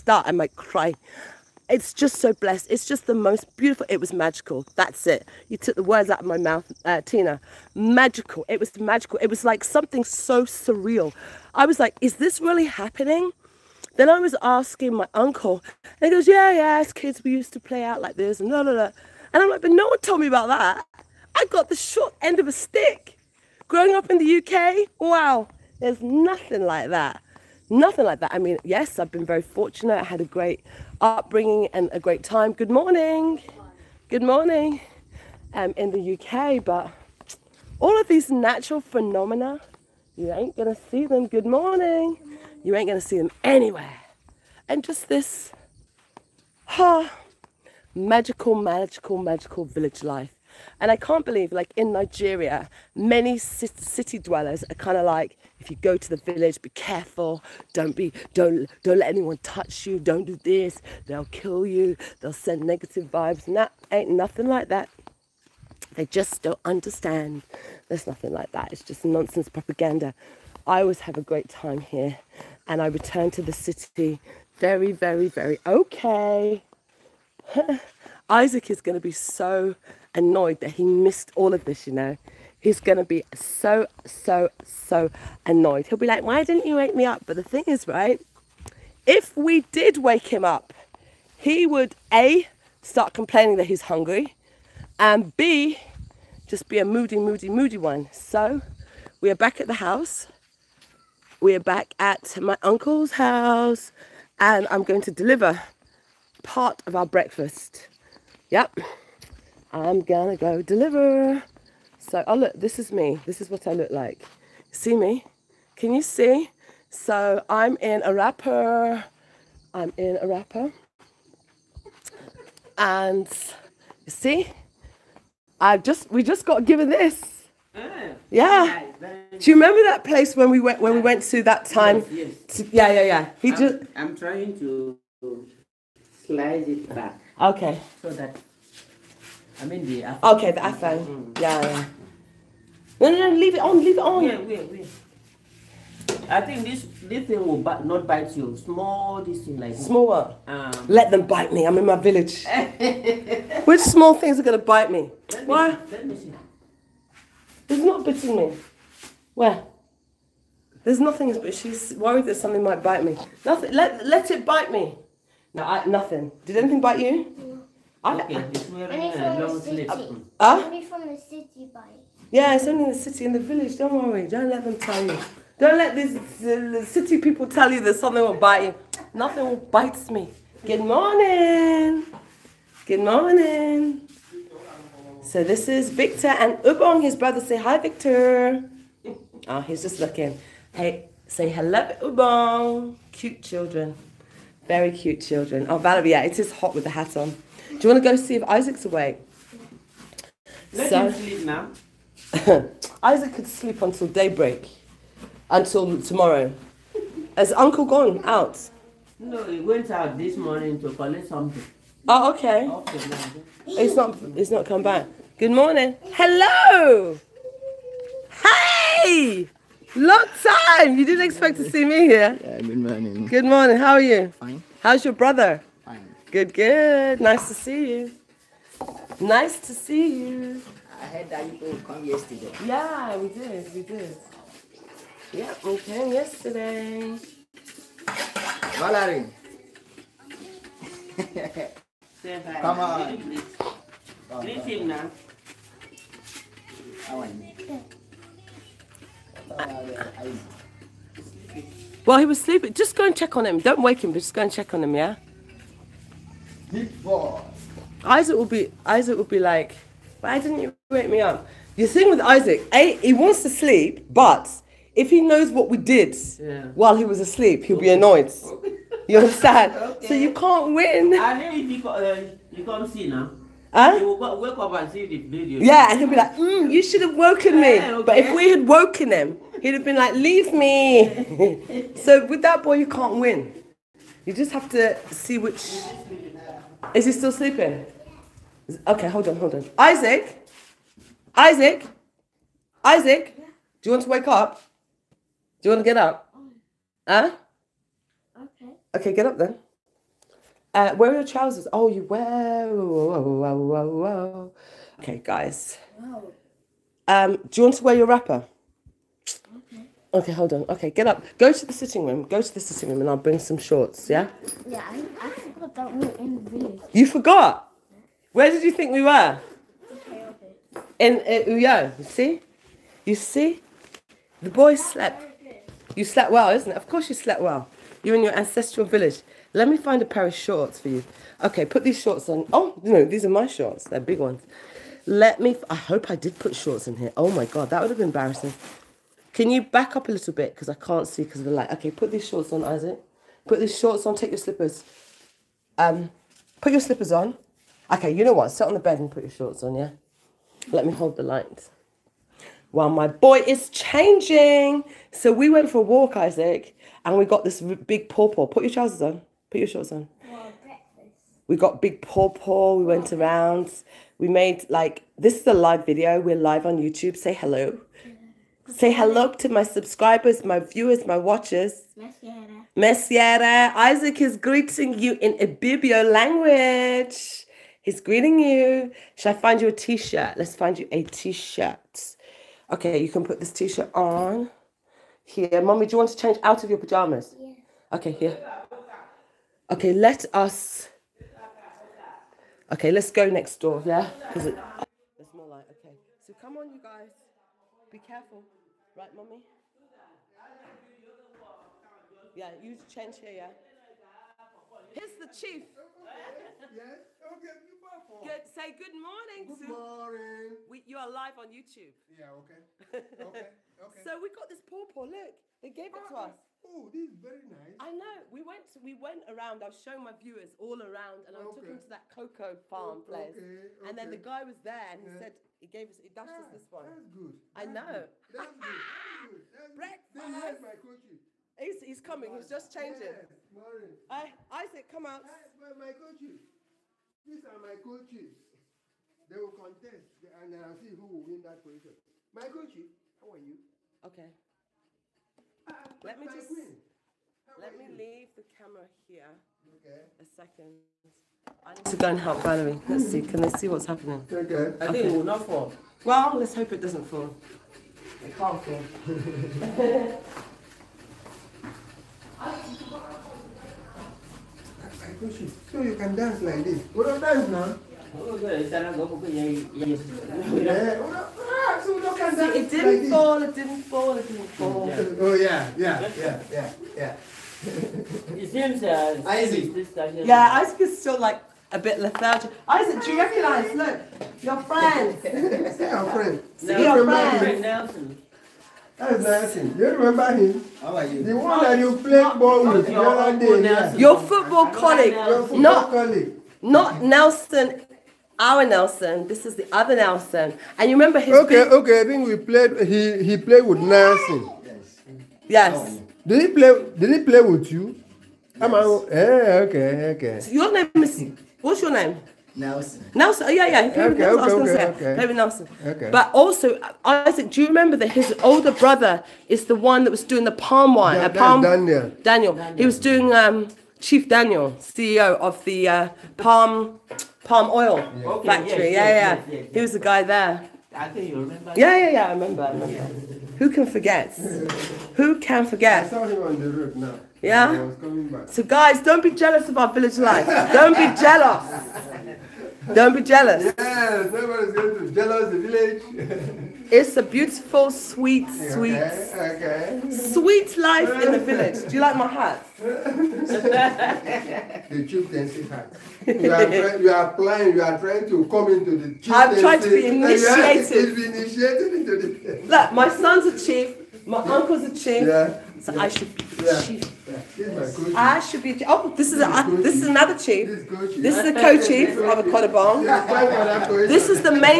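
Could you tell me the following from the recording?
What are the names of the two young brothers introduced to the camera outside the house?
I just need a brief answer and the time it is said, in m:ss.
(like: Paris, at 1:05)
Victor and Ubong, at 3:05.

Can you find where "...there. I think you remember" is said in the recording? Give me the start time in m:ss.
8:50.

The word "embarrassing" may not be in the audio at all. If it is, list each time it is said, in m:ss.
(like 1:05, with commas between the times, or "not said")
5:38.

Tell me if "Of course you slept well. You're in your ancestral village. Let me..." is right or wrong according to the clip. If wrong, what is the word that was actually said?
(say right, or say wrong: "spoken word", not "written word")
right.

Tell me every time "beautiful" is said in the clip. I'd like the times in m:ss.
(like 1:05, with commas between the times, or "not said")
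0:03, 9:07.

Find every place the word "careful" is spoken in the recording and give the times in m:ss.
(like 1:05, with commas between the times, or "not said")
0:56, 6:37.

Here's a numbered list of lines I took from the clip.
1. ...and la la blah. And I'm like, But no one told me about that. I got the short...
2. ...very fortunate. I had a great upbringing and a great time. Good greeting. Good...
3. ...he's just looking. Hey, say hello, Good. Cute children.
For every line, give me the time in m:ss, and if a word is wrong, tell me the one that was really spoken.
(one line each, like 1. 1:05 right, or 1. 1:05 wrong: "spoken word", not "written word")
1. 0:18 right
2. 0:29 wrong: "morning", not "greeting"
3. 3:09 wrong: "Ubong", not "Good".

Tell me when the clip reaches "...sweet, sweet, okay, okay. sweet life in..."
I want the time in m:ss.
9:07.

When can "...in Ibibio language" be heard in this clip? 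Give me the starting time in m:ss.
6:15.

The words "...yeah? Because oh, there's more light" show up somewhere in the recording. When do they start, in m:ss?
6:33.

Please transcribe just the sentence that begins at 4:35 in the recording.
Yeah, and he would be like, mm, you should have woken me.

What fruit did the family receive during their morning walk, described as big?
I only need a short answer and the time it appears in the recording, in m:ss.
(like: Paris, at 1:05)
Pawpaw, at 5:57.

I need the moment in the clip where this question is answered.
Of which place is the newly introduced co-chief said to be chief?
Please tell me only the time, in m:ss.
9:32.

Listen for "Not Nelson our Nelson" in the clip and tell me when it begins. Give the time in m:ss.
8:16.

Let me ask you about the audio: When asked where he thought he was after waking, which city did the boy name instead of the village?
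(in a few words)
Uyo.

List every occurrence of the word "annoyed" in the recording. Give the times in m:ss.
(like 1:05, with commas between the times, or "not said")
1:20, 1:25, 4:27.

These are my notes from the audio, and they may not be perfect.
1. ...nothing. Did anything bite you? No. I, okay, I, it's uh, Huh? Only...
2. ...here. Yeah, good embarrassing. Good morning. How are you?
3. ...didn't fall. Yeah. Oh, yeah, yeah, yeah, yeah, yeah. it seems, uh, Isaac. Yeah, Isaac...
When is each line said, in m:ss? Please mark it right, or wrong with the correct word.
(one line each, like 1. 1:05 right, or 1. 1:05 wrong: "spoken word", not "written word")
1. 2:45 right
2. 3:42 wrong: "morning", not "embarrassing"
3. 7:54 right.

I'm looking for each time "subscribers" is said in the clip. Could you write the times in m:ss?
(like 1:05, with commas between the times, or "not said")
6:09.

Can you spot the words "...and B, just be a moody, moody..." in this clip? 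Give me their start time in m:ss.
1:34.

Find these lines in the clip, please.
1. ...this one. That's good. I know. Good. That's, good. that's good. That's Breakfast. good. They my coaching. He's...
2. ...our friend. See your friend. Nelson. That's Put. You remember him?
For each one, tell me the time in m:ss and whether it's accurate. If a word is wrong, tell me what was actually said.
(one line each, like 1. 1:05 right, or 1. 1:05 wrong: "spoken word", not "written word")
1. 7:06 right
2. 8:06 wrong: "Nelson", not "Put".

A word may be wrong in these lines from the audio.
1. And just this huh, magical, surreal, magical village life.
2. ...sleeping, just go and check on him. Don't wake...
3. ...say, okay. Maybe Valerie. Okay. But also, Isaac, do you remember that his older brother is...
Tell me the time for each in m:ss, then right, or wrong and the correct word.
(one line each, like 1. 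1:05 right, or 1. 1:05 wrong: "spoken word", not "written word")
1. 0:44 wrong: "magical", not "surreal"
2. 4:12 right
3. 8:34 wrong: "Nelson", not "Valerie".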